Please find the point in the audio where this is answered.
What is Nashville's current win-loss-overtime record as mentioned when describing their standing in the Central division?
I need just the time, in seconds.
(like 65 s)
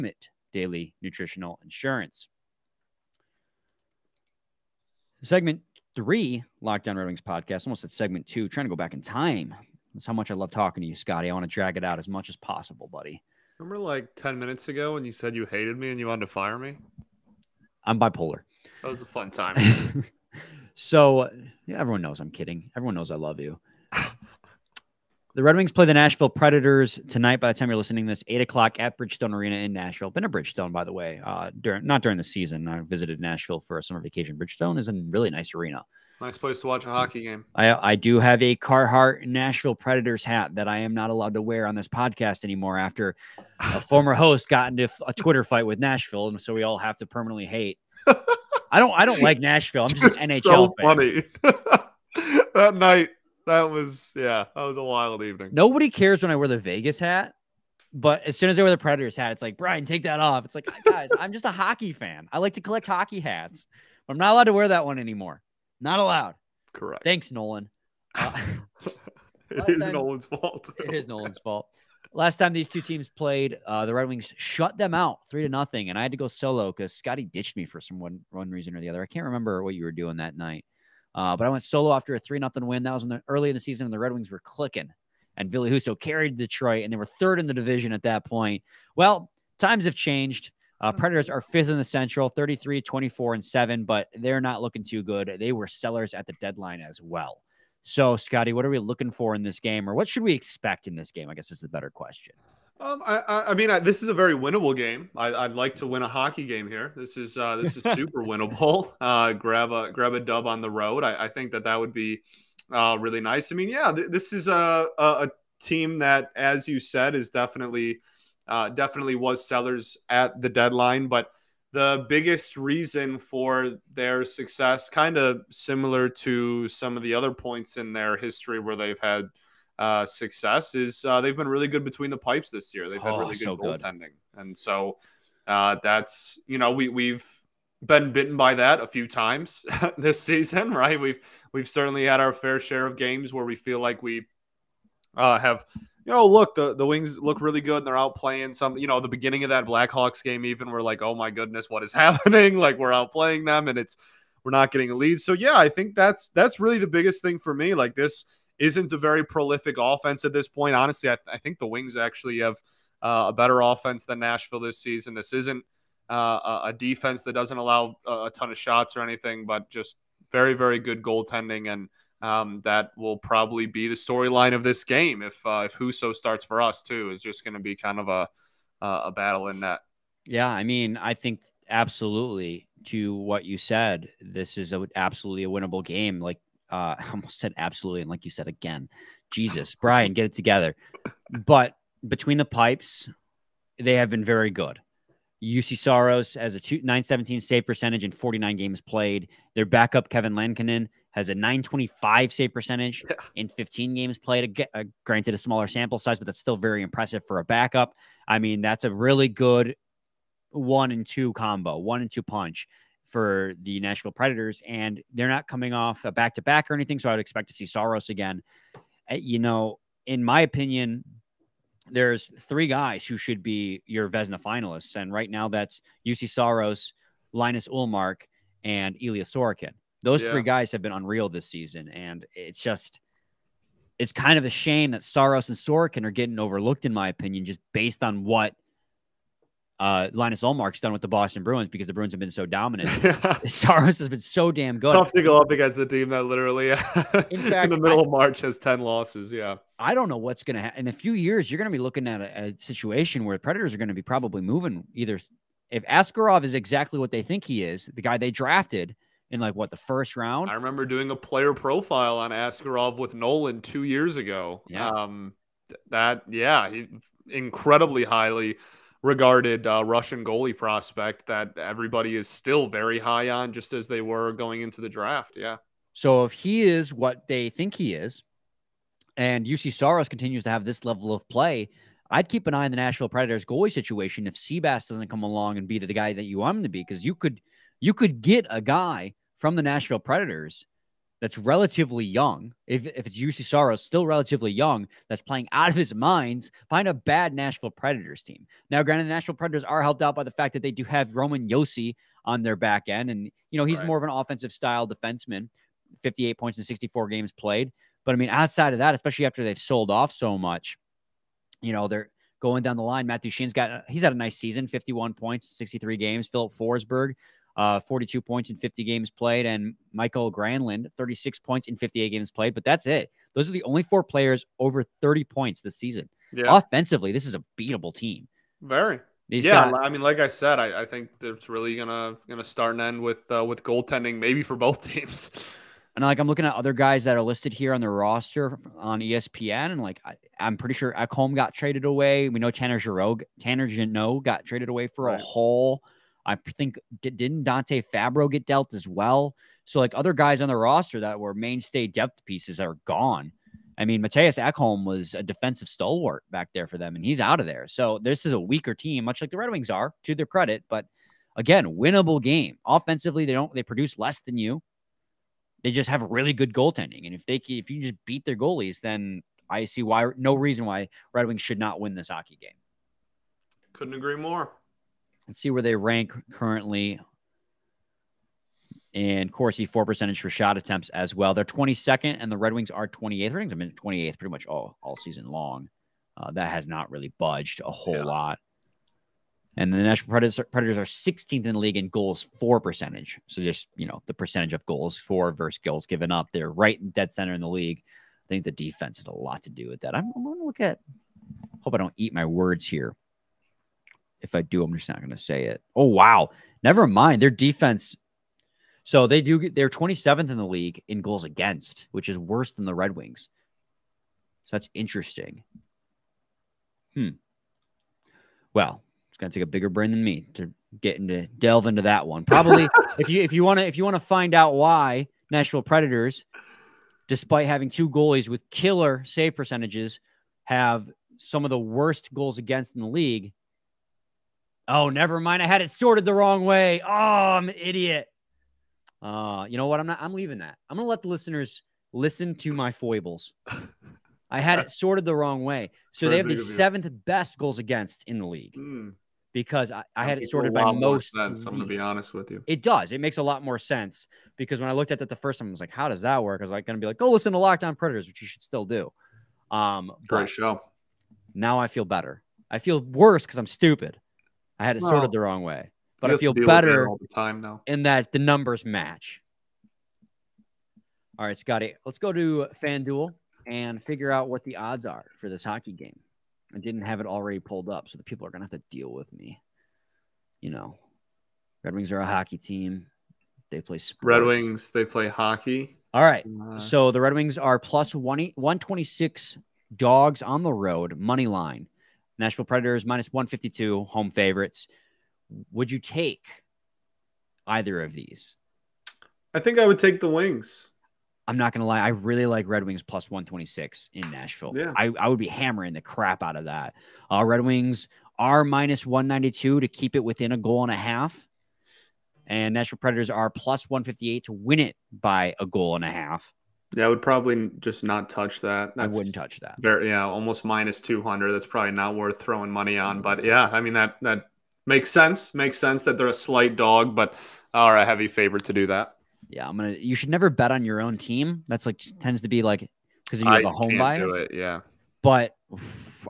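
92 s.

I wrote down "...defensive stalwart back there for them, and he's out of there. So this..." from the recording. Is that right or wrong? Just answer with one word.
right.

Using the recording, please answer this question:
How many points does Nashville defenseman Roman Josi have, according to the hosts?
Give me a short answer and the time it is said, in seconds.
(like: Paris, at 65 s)
58, at 306 s.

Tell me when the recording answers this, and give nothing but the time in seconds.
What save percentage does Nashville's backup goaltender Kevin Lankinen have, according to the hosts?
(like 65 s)
201 s.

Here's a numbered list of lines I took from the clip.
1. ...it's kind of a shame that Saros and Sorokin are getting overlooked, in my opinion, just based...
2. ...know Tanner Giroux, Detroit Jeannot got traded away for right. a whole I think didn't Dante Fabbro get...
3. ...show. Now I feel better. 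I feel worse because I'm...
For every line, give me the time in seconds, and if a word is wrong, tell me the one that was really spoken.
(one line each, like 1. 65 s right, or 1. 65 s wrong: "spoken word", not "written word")
1. 233 s right
2. 342 s wrong: "Tanner", not "Detroit"
3. 460 s right.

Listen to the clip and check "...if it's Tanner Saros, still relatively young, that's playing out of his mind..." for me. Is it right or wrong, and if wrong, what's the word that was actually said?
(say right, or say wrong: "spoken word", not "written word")
wrong: "Juuse", not "Tanner".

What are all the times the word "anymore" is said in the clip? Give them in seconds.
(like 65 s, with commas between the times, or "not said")
42 s, 64 s.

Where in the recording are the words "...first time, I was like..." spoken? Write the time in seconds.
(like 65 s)
455 s.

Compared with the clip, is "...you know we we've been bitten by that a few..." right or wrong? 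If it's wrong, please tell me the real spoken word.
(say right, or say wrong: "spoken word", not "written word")
right.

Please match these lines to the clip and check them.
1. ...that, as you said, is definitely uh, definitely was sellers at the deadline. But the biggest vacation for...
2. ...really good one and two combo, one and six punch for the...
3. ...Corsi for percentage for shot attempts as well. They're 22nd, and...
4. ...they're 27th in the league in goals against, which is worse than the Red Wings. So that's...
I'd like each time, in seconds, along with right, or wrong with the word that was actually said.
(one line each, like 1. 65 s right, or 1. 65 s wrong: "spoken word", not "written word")
1. 115 s wrong: "reason", not "vacation"
2. 208 s wrong: "two", not "six"
3. 379 s right
4. 409 s right.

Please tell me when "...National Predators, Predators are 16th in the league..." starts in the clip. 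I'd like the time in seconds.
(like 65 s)
389 s.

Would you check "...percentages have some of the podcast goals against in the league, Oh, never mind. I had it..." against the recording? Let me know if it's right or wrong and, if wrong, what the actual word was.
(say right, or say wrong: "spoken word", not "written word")
wrong: "worst", not "podcast".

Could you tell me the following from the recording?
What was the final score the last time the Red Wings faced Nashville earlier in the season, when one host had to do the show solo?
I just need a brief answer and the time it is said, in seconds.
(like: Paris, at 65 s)
3-0, at 75 s.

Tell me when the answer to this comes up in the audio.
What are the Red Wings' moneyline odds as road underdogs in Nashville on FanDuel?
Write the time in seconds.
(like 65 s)
487 s.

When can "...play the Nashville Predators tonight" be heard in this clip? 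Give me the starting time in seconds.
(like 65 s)
25 s.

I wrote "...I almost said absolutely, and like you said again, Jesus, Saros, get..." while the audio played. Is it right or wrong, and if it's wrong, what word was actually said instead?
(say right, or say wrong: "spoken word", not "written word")
wrong: "Brian", not "Saros".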